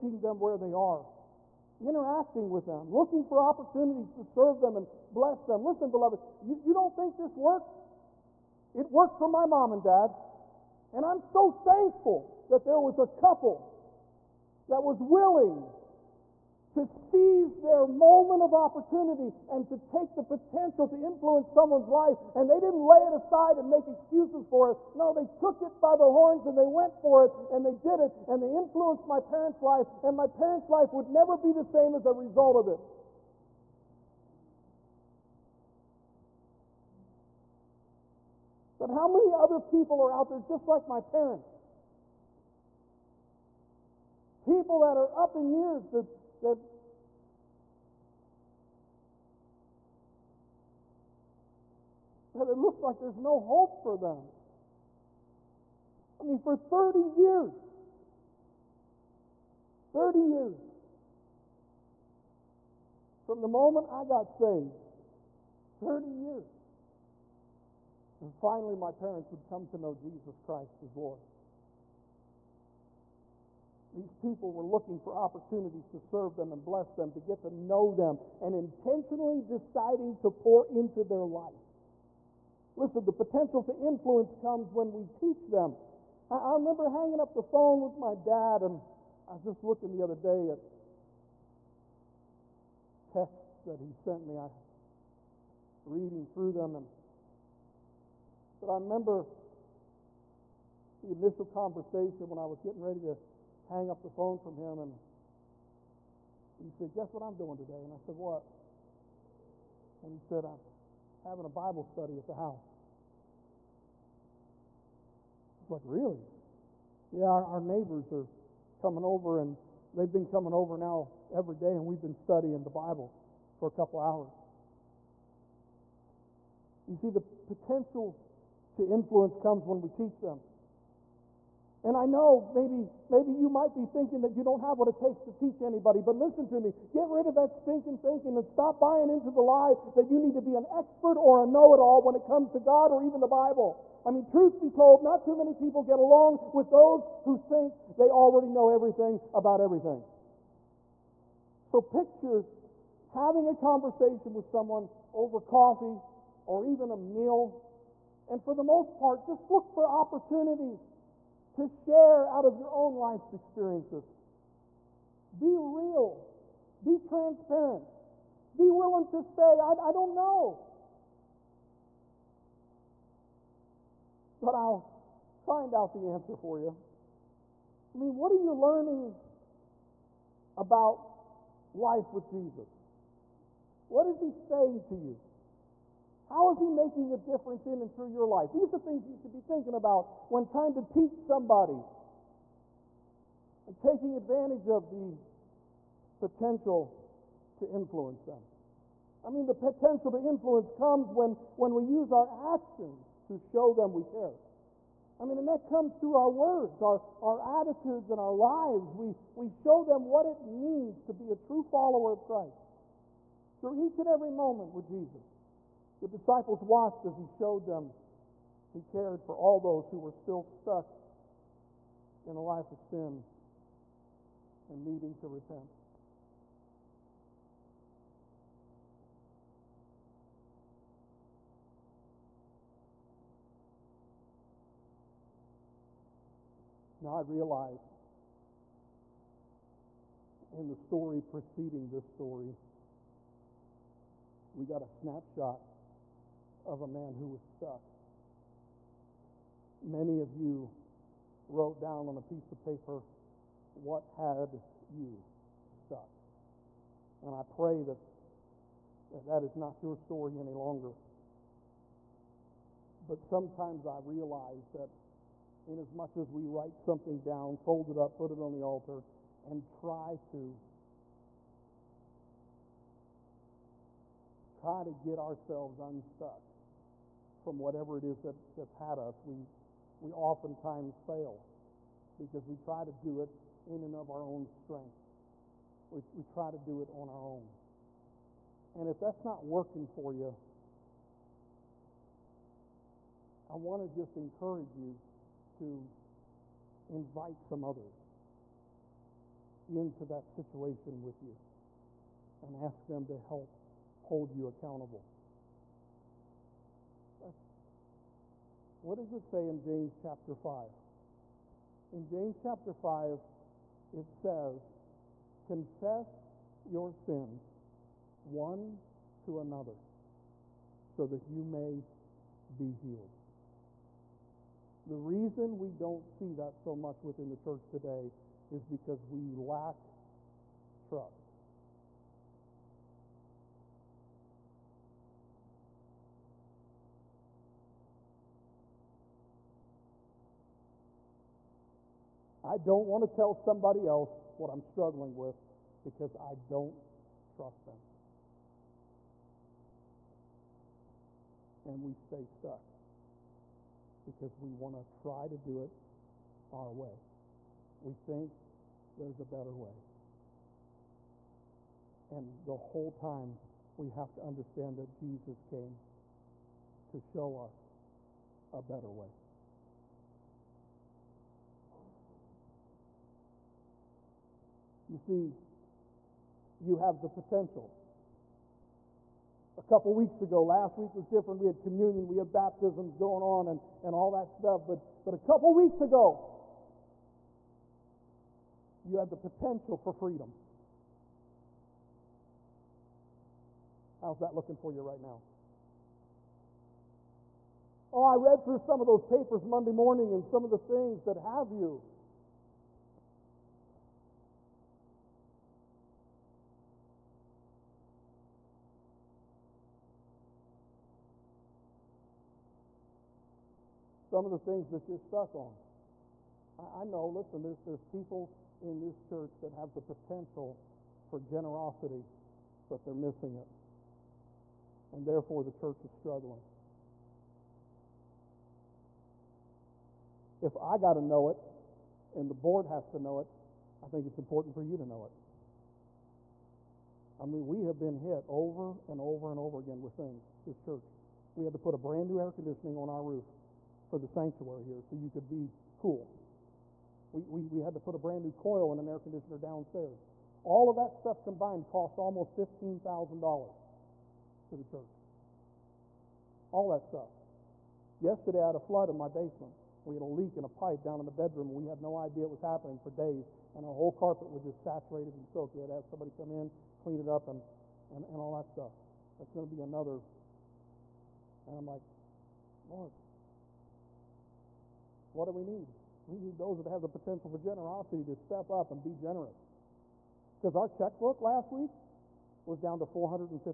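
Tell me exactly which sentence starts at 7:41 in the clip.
We had no idea it was happening for days, and our whole carpet was just saturated and soaked.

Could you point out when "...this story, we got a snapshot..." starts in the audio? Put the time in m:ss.
4:01.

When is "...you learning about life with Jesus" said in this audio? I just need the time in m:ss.
2:58.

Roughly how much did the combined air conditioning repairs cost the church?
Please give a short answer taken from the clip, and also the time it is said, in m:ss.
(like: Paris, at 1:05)
$15,000, at 7:32.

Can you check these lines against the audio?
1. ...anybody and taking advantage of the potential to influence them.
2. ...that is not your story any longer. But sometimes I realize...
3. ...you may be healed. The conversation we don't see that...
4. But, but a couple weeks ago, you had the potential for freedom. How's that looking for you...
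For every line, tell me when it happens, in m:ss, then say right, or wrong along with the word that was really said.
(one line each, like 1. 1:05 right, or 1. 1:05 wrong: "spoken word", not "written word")
1. 3:11 wrong: "somebody", not "anybody"
2. 4:19 right
3. 5:21 wrong: "reason", not "conversation"
4. 6:24 right.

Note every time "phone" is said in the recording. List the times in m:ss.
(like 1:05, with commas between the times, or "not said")
1:27, 1:44.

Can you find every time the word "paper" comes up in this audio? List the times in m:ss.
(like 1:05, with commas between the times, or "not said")
4:12, 6:39.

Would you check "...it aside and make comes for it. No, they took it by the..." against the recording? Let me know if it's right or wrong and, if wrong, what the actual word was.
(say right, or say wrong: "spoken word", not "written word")
wrong: "excuses", not "comes".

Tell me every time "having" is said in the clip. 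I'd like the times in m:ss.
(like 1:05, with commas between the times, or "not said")
1:51, 2:33.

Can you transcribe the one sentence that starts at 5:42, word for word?
I don't want to tell somebody else what I'm struggling with because I don't trust them.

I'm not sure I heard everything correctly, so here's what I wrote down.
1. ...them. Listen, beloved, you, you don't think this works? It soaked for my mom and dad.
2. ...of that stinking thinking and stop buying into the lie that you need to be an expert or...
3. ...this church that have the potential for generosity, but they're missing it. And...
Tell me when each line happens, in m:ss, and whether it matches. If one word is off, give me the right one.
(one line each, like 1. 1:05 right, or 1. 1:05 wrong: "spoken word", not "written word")
1. 0:05 wrong: "worked", not "soaked"
2. 2:17 right
3. 6:58 right.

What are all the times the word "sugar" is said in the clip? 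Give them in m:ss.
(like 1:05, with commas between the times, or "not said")
not said.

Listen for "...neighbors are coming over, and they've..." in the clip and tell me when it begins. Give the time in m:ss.
1:57.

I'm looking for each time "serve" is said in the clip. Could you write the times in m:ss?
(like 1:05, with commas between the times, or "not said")
0:04, 1:15.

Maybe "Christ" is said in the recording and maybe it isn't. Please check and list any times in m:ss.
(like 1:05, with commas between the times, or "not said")
1:10, 3:32.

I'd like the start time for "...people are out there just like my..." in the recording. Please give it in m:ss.
0:39.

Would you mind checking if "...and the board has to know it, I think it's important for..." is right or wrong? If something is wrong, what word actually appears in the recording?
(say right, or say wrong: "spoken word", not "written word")
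right.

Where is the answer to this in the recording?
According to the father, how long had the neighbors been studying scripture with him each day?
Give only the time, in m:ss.
2:03.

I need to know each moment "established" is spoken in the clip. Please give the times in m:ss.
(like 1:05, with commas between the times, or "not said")
not said.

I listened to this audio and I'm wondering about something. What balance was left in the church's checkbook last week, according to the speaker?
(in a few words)
$457.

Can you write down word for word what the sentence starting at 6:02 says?
And the whole time, we have to understand that Jesus came to show us a better way.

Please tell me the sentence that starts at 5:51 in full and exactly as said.
And we stay stuck because we want to try to do it our way.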